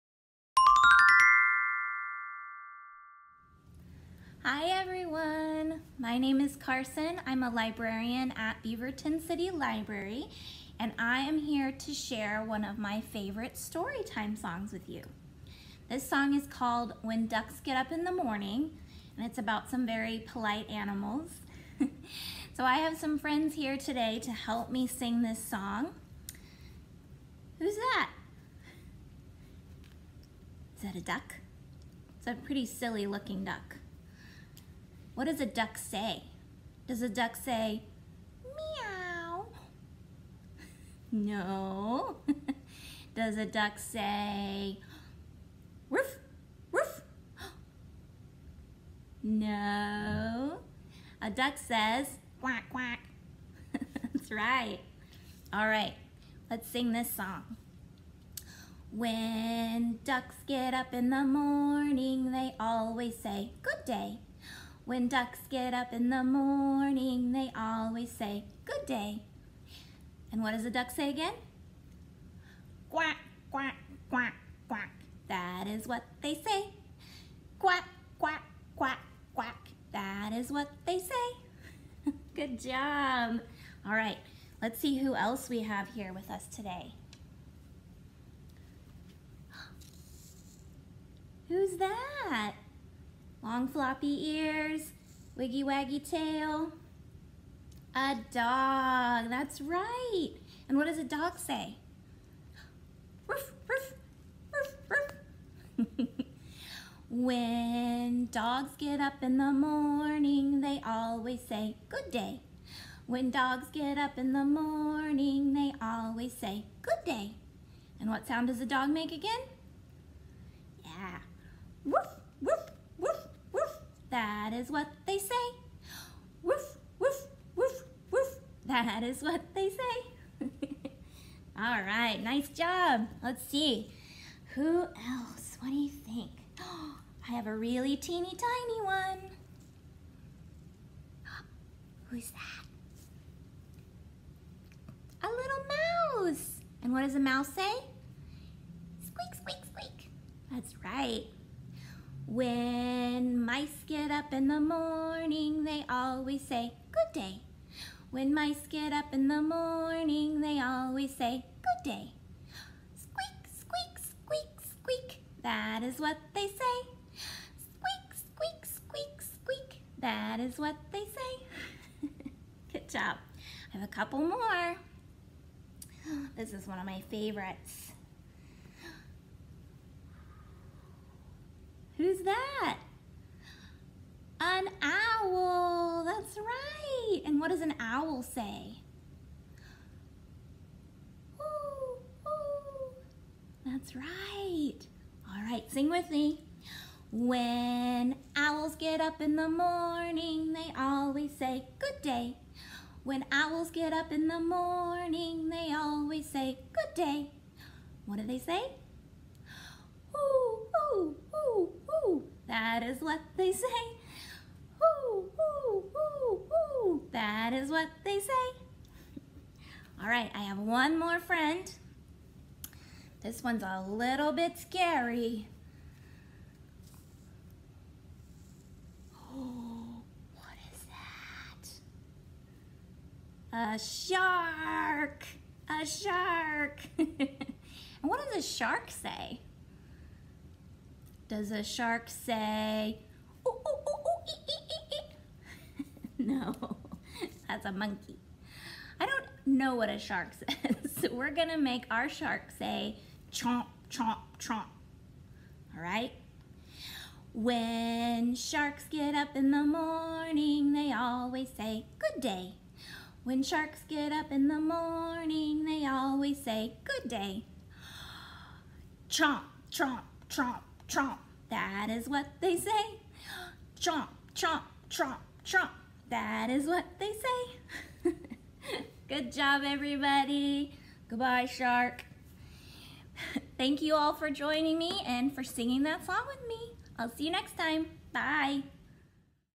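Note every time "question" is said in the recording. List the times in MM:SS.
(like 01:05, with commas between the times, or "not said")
not said.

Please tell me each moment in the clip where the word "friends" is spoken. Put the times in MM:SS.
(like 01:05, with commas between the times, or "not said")
00:23, 03:41.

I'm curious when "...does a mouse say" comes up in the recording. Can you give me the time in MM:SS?
02:27.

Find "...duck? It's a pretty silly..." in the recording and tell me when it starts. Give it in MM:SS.
00:31.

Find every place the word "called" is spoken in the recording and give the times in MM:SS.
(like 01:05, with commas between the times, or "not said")
00:16.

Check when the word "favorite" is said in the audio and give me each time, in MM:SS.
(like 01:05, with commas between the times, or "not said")
00:13, 02:57.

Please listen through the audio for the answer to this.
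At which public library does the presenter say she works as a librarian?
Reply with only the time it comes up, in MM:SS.
00:08.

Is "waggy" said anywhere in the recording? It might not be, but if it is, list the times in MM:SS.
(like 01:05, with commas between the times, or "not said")
01:35.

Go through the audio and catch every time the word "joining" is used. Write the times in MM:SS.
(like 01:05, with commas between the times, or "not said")
04:44.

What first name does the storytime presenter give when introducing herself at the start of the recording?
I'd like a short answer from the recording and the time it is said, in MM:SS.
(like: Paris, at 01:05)
Carson, at 00:06.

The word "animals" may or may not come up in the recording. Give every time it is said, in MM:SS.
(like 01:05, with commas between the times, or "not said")
00:20.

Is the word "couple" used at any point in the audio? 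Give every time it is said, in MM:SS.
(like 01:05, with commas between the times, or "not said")
02:53.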